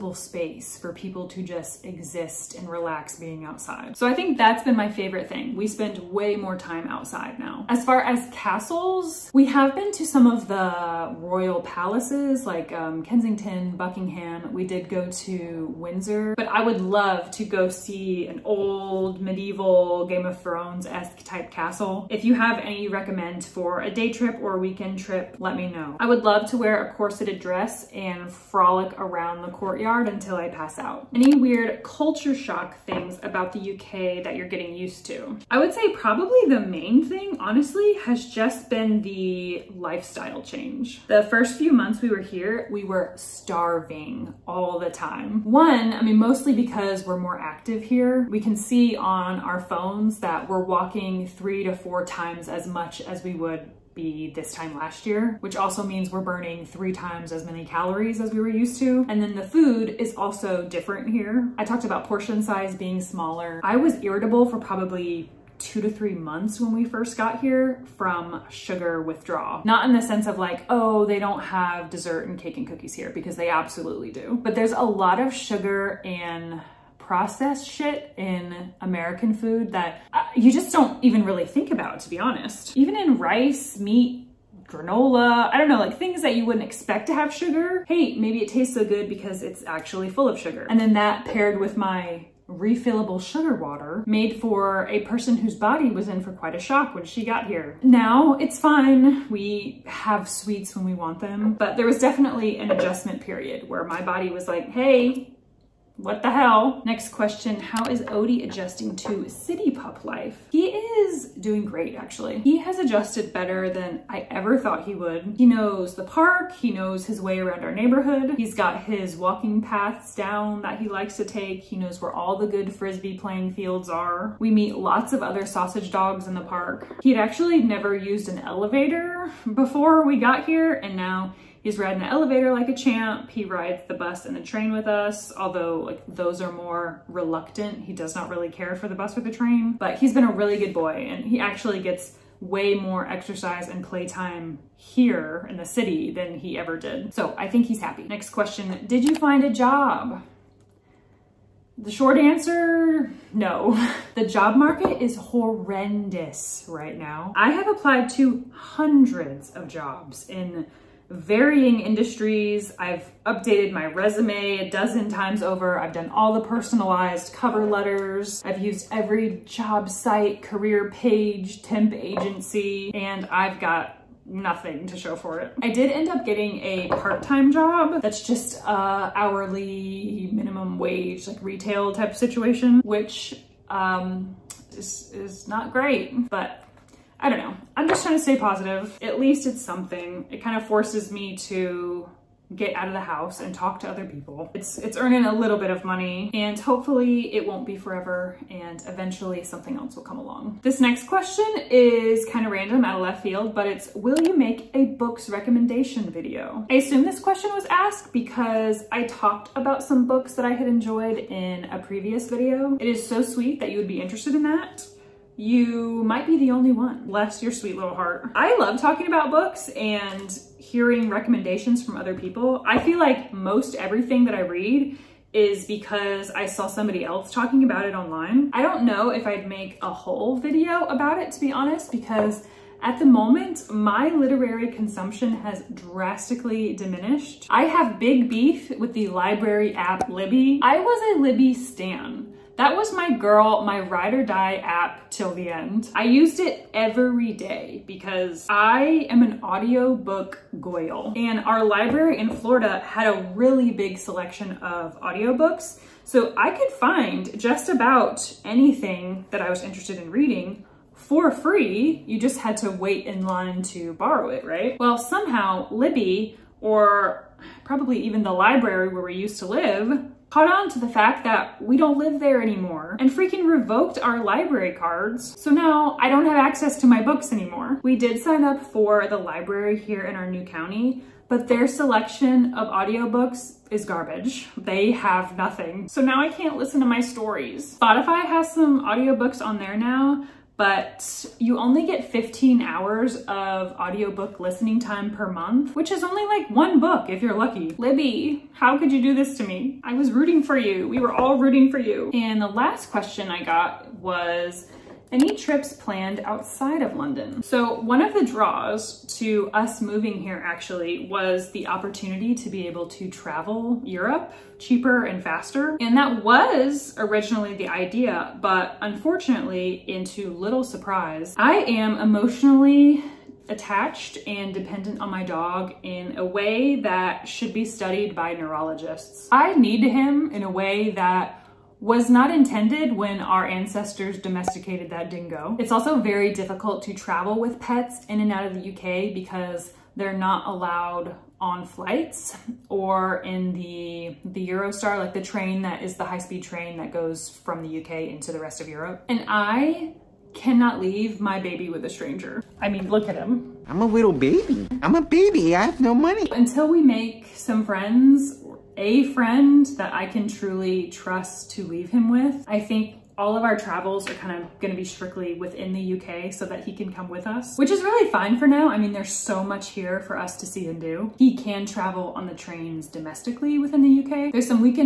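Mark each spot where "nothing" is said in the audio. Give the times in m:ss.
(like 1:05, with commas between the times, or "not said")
2:54, 4:45.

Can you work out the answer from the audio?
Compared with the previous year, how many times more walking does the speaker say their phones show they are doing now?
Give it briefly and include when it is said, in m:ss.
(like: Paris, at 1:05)
3 to 4 times, at 0:51.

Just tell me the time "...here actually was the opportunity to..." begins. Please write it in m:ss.
5:10.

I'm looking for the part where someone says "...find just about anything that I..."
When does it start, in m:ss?
4:16.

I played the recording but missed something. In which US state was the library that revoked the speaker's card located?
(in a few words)
Florida.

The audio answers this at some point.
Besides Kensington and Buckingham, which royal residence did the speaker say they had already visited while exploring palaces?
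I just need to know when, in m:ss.
0:15.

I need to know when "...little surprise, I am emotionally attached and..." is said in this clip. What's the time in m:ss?
5:20.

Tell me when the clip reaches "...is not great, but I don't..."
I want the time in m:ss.
3:05.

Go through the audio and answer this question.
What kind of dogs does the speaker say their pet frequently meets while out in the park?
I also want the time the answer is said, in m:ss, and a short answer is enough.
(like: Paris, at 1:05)
Sausage dogs, at 2:05.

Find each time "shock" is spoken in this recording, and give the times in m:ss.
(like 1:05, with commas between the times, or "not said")
0:32, 1:36.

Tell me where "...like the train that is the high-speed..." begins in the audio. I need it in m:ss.
5:45.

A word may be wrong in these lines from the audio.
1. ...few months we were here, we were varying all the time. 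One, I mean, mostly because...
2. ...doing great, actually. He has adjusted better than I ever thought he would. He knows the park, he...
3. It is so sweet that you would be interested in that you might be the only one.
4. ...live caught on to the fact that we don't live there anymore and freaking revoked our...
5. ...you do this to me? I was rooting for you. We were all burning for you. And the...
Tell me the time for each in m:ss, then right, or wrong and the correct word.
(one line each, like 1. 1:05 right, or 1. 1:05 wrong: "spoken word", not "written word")
1. 0:41 wrong: "starving", not "varying"
2. 1:51 right
3. 3:32 right
4. 4:29 right
5. 4:58 wrong: "rooting", not "burning".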